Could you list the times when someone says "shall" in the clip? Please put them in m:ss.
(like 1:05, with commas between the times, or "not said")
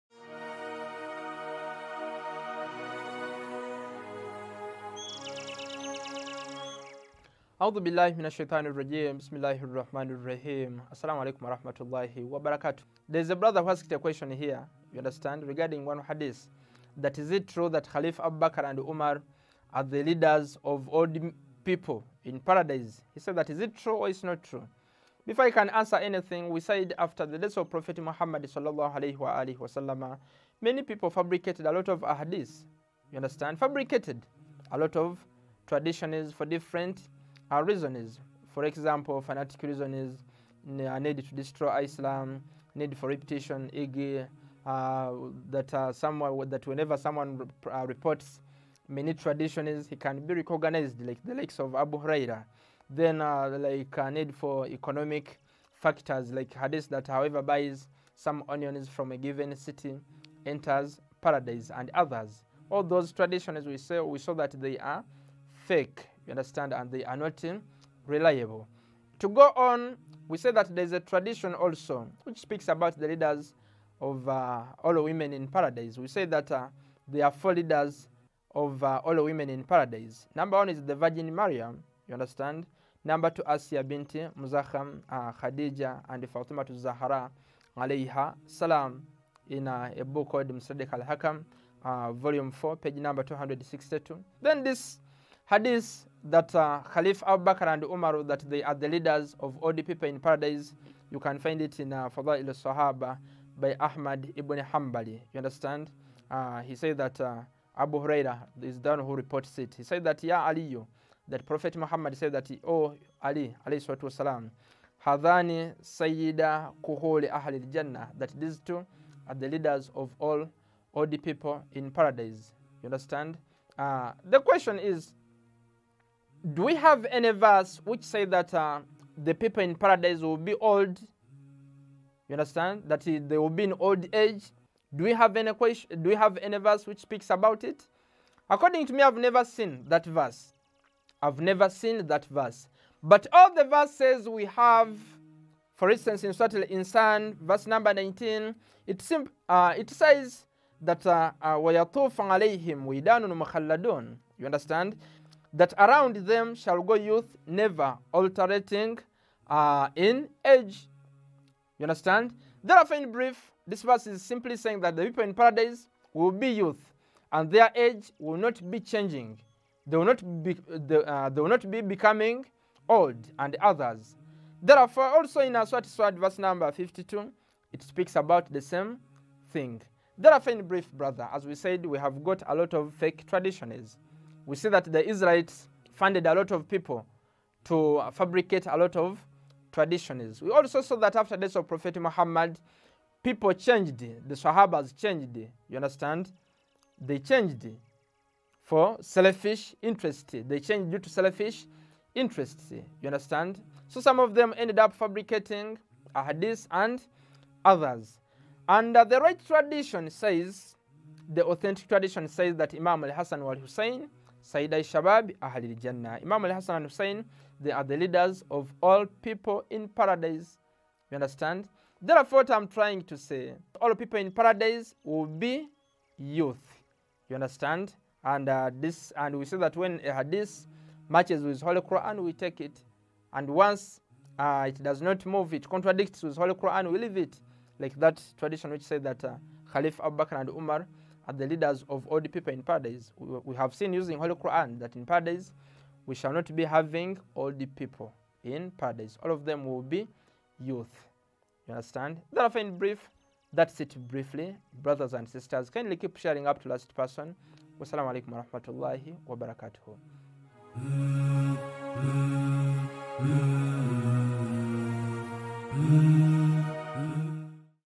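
2:36, 4:06.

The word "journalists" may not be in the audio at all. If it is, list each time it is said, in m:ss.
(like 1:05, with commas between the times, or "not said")
not said.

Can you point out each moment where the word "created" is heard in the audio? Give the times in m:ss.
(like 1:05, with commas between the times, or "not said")
not said.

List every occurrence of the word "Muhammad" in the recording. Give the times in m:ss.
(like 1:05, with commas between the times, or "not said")
0:27, 1:51, 3:11.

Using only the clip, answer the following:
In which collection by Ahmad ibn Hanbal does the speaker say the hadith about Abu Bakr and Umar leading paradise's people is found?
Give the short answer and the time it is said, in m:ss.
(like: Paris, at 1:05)
Fadail al-Sahaba, at 1:42.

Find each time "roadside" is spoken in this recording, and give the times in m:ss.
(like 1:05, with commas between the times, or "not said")
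not said.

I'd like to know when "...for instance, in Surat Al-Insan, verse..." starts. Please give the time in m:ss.
2:25.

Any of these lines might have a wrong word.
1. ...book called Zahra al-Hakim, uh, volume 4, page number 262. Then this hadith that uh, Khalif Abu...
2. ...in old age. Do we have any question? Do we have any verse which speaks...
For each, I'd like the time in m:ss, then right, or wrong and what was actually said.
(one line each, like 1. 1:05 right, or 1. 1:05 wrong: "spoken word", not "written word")
1. 1:30 wrong: "Mustadrak", not "Zahra"
2. 2:13 right.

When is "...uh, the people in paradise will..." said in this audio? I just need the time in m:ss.
2:08.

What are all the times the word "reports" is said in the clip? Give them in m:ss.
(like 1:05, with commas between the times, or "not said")
0:47, 1:49.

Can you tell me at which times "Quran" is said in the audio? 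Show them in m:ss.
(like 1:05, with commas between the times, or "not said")
3:51, 3:56, 4:04.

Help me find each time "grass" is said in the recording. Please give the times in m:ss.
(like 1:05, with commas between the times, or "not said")
not said.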